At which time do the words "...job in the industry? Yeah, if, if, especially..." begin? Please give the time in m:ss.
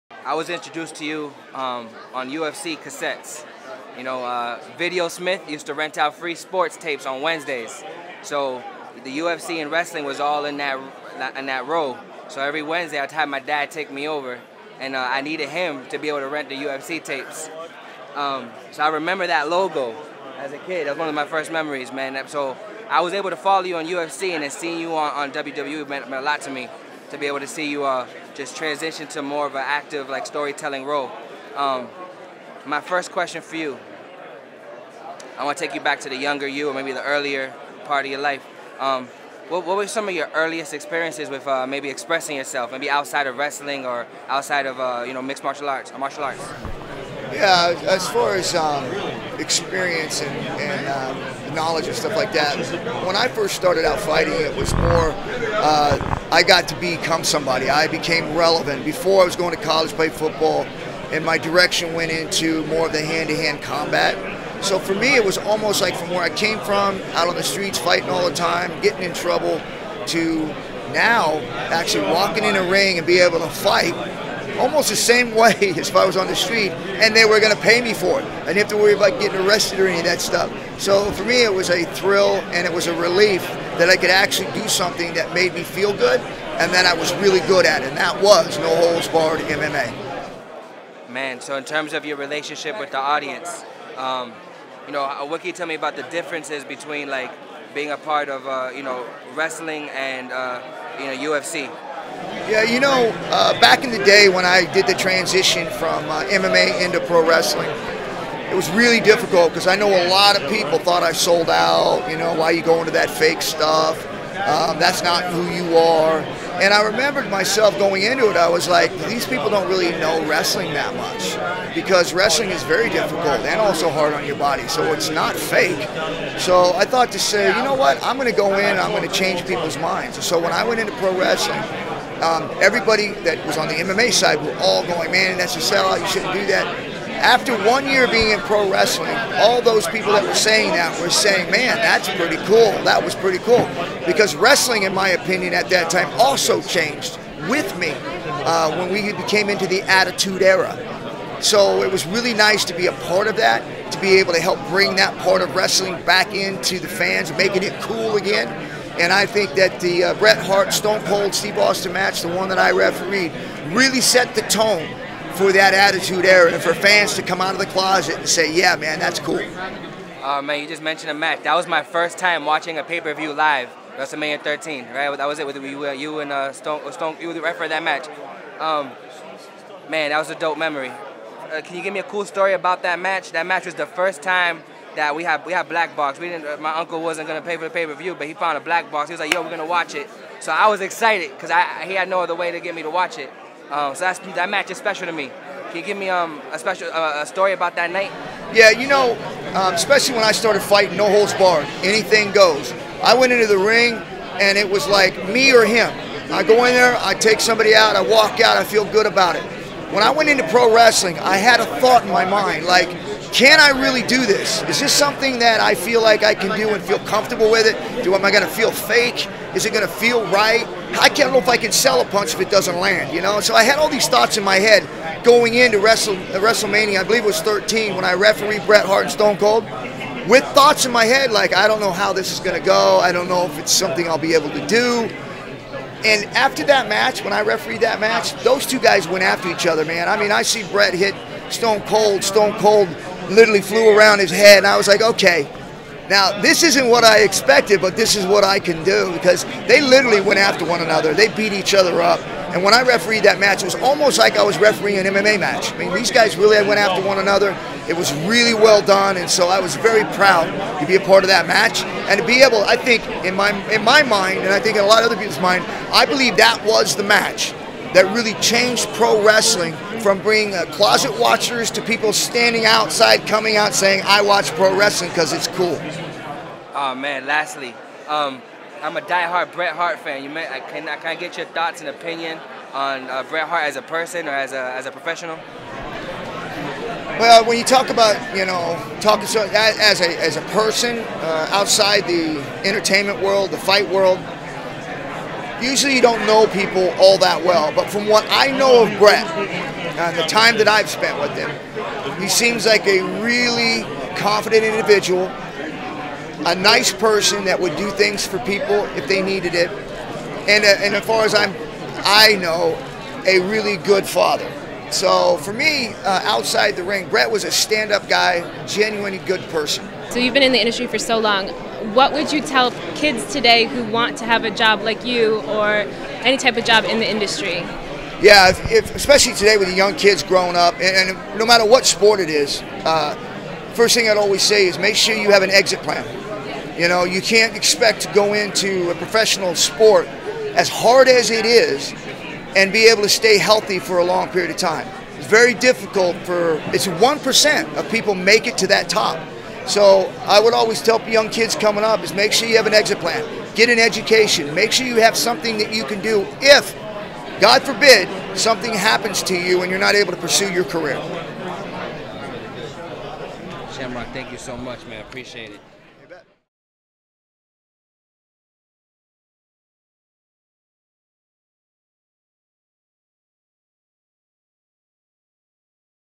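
5:26.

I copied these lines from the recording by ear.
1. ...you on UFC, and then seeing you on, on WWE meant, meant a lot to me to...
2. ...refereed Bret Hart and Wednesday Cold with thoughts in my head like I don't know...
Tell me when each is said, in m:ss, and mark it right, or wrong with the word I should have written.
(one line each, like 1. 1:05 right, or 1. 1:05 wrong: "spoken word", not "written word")
1. 0:23 right
2. 3:48 wrong: "Stone", not "Wednesday".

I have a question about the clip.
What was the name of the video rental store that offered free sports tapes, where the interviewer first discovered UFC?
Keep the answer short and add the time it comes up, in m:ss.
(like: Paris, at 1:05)
Video Smith, at 0:04.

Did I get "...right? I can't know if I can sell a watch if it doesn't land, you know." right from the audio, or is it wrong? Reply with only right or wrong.
wrong.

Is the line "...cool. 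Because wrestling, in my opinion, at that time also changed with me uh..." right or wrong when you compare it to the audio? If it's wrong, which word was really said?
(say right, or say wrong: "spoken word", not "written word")
right.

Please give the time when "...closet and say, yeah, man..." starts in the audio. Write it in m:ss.
2:47.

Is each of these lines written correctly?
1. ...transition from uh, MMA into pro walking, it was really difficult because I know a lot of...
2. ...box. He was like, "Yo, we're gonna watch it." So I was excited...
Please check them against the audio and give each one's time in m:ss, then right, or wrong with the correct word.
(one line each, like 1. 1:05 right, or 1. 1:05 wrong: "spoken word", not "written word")
1. 1:44 wrong: "wrestling", not "walking"
2. 3:08 right.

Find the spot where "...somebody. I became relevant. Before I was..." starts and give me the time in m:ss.
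0:57.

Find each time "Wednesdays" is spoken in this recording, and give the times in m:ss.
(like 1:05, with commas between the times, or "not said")
0:07, 0:12.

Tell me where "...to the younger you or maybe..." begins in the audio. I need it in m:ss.
0:36.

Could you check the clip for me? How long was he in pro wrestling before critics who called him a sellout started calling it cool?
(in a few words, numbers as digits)
One year.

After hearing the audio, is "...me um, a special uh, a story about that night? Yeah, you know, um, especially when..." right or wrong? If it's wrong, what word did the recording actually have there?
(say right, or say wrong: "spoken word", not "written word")
right.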